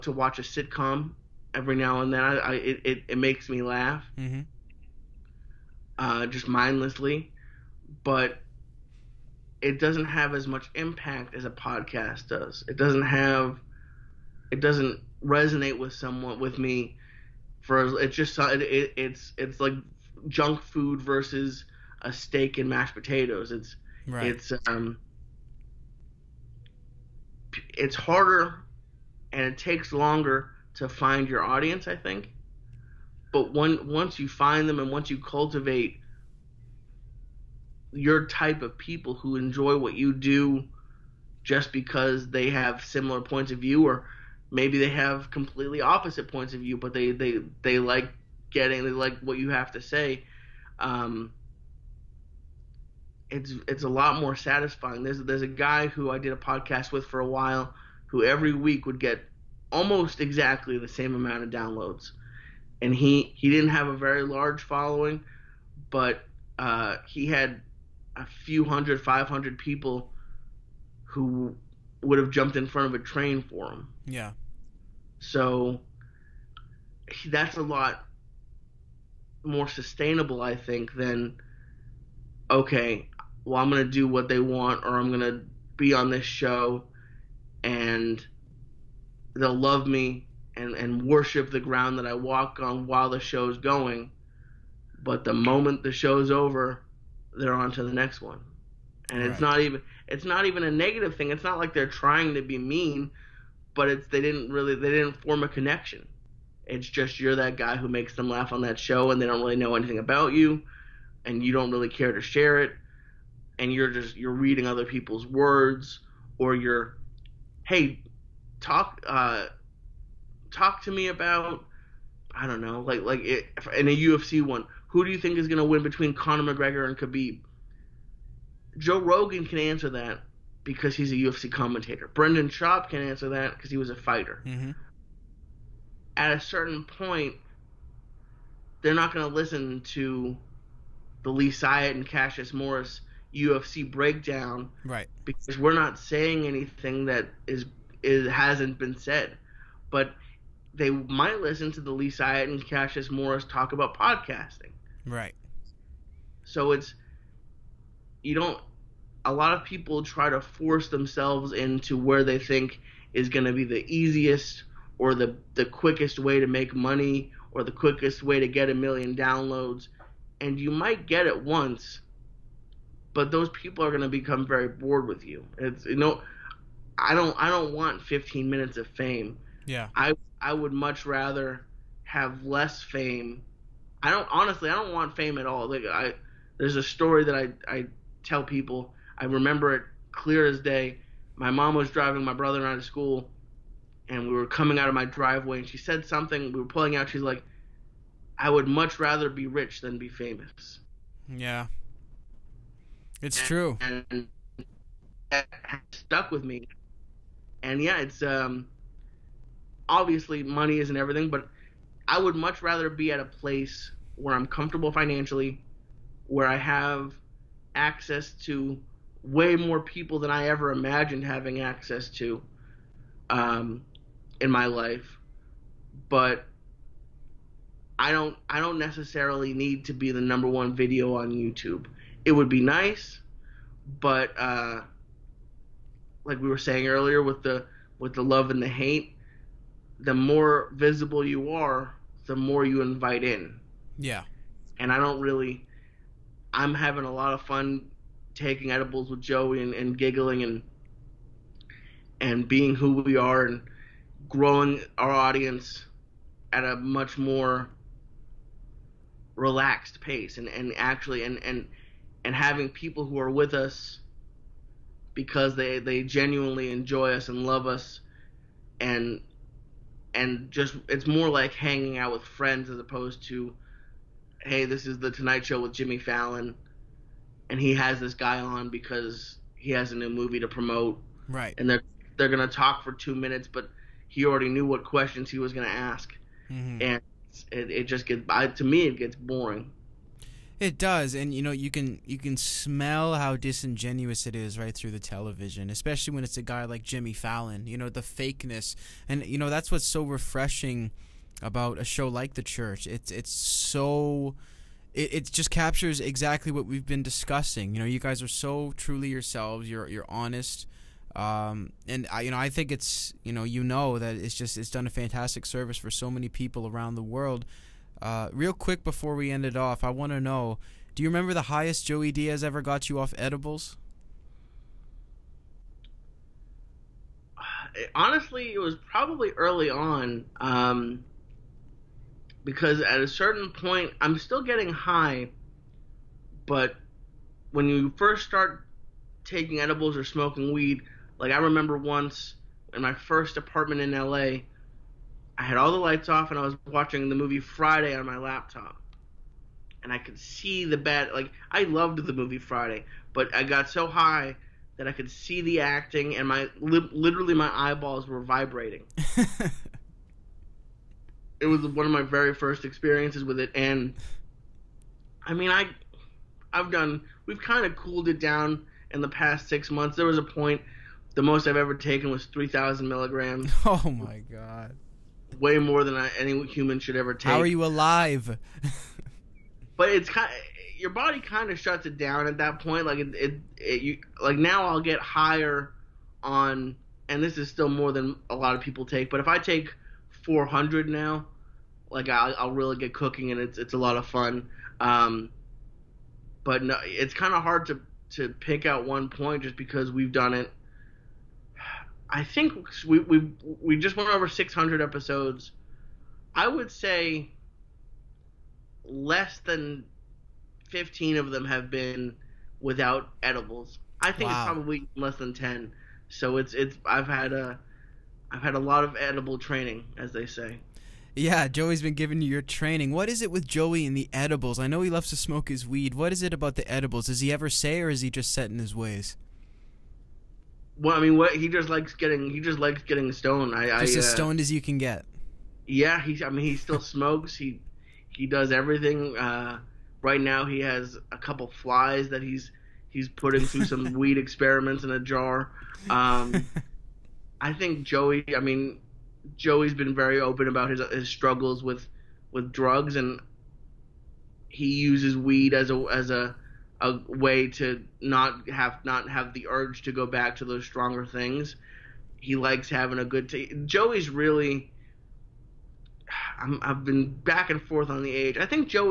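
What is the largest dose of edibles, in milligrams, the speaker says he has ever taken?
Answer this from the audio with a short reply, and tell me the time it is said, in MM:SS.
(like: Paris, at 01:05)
3000, at 06:12.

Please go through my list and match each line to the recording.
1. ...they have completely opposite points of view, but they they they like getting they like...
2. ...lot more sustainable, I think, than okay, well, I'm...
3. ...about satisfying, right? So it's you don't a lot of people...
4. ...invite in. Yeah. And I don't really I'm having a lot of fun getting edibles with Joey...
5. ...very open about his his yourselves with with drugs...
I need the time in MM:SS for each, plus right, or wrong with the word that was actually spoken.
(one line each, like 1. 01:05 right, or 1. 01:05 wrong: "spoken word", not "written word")
1. 00:44 right
2. 01:17 right
3. 02:33 wrong: "podcasting", not "satisfying"
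4. 04:02 wrong: "taking", not "getting"
5. 07:29 wrong: "struggles", not "yourselves".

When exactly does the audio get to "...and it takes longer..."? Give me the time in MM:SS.
00:29.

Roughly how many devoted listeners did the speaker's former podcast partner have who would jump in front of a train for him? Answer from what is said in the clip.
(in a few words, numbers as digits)
500.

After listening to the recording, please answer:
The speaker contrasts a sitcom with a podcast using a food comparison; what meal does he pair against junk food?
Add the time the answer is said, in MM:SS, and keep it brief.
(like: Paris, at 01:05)
steak and mashed potatoes, at 00:22.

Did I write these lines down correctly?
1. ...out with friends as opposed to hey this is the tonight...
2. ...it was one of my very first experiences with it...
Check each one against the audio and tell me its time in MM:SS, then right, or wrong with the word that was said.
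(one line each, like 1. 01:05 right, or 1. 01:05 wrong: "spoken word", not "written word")
1. 04:31 right
2. 06:01 right.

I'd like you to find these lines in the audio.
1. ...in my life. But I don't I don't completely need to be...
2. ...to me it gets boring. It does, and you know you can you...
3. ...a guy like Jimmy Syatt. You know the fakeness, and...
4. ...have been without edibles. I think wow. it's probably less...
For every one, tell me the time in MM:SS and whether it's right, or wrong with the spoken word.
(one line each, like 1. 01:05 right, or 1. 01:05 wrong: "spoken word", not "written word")
1. 03:44 wrong: "necessarily", not "completely"
2. 04:48 right
3. 04:56 wrong: "Fallon", not "Syatt"
4. 06:51 right.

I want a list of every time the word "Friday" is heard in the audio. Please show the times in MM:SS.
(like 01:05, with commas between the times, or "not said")
05:47, 05:52.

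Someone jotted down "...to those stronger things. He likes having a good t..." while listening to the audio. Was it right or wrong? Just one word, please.
right.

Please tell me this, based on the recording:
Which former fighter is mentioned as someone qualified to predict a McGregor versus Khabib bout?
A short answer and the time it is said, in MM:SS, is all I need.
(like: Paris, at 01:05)
Brendan Schaub, at 02:12.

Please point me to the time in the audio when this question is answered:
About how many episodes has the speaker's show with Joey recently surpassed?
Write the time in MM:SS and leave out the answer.
06:44.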